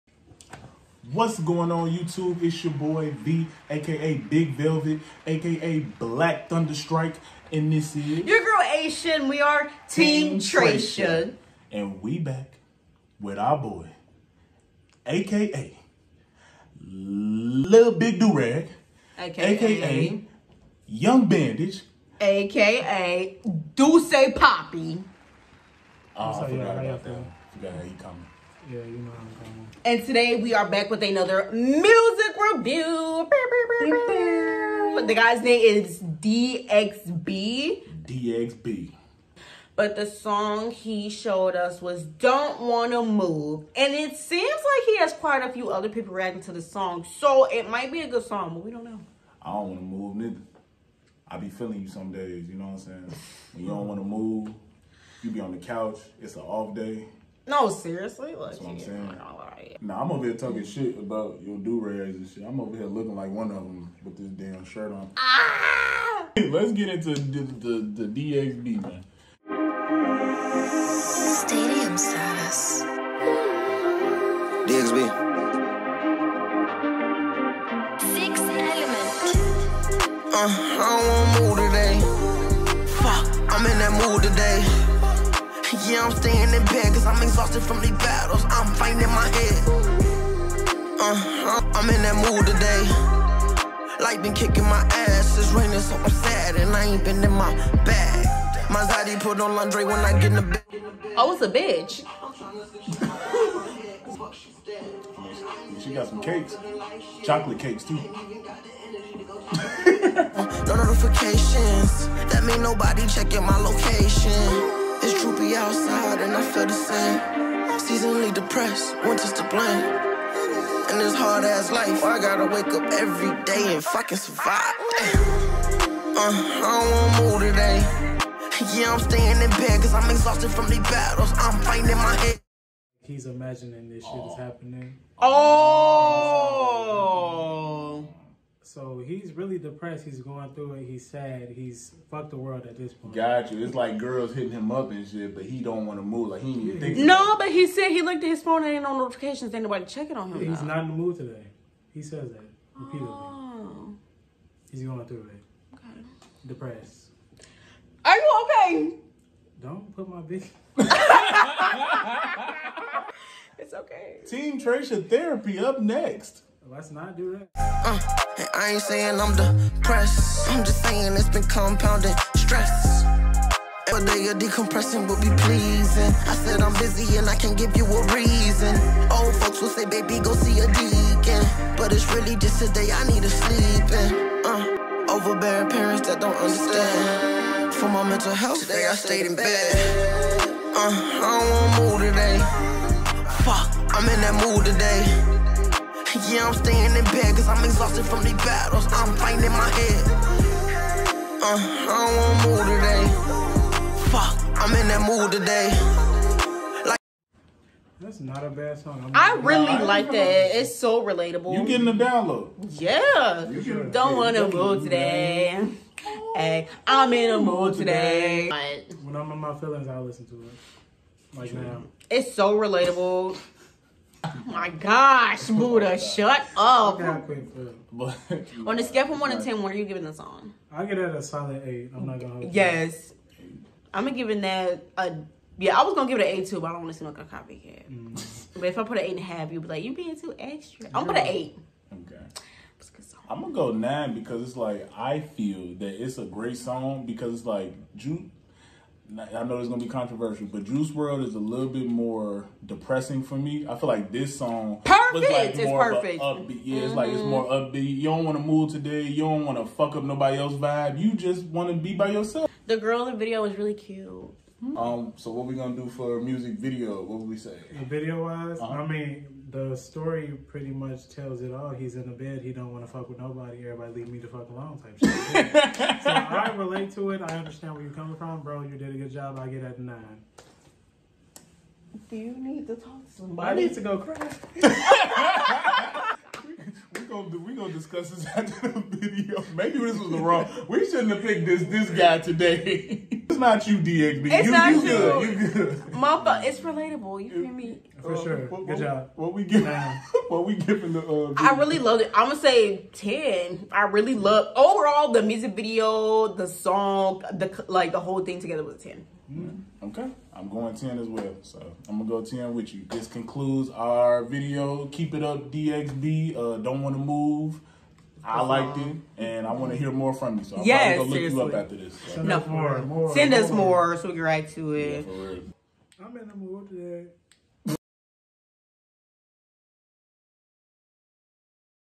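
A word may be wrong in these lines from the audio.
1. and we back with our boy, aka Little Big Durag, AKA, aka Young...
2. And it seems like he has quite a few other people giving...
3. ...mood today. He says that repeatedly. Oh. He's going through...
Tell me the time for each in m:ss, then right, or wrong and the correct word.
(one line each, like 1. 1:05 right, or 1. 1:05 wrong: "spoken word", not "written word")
1. 0:11 right
2. 0:43 wrong: "reacting", not "giving"
3. 2:30 right.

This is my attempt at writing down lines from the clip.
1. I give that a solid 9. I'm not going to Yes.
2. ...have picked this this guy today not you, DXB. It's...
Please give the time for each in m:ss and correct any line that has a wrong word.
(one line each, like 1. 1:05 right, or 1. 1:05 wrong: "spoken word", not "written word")
1. 3:50 wrong: "8", not "9"
2. 4:51 right.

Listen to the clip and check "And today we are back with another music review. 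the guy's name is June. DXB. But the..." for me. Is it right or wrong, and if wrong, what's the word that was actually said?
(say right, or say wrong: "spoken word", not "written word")
wrong: "DXB", not "June".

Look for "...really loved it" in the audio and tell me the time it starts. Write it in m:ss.
5:01.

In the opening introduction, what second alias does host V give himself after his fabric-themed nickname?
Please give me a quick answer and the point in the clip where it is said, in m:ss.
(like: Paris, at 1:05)
Black Thunderstrike, at 0:05.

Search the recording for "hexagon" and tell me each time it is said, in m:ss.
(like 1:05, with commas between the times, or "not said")
not said.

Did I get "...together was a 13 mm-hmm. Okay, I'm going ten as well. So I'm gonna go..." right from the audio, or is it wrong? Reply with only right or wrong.
wrong.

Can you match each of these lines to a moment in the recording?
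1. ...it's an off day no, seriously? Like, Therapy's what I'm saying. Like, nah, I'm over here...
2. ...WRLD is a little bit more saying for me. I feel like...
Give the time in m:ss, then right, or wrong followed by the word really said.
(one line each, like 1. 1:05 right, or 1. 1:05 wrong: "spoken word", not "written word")
1. 0:56 wrong: "That", not "Therapy"
2. 4:10 wrong: "depressing", not "saying".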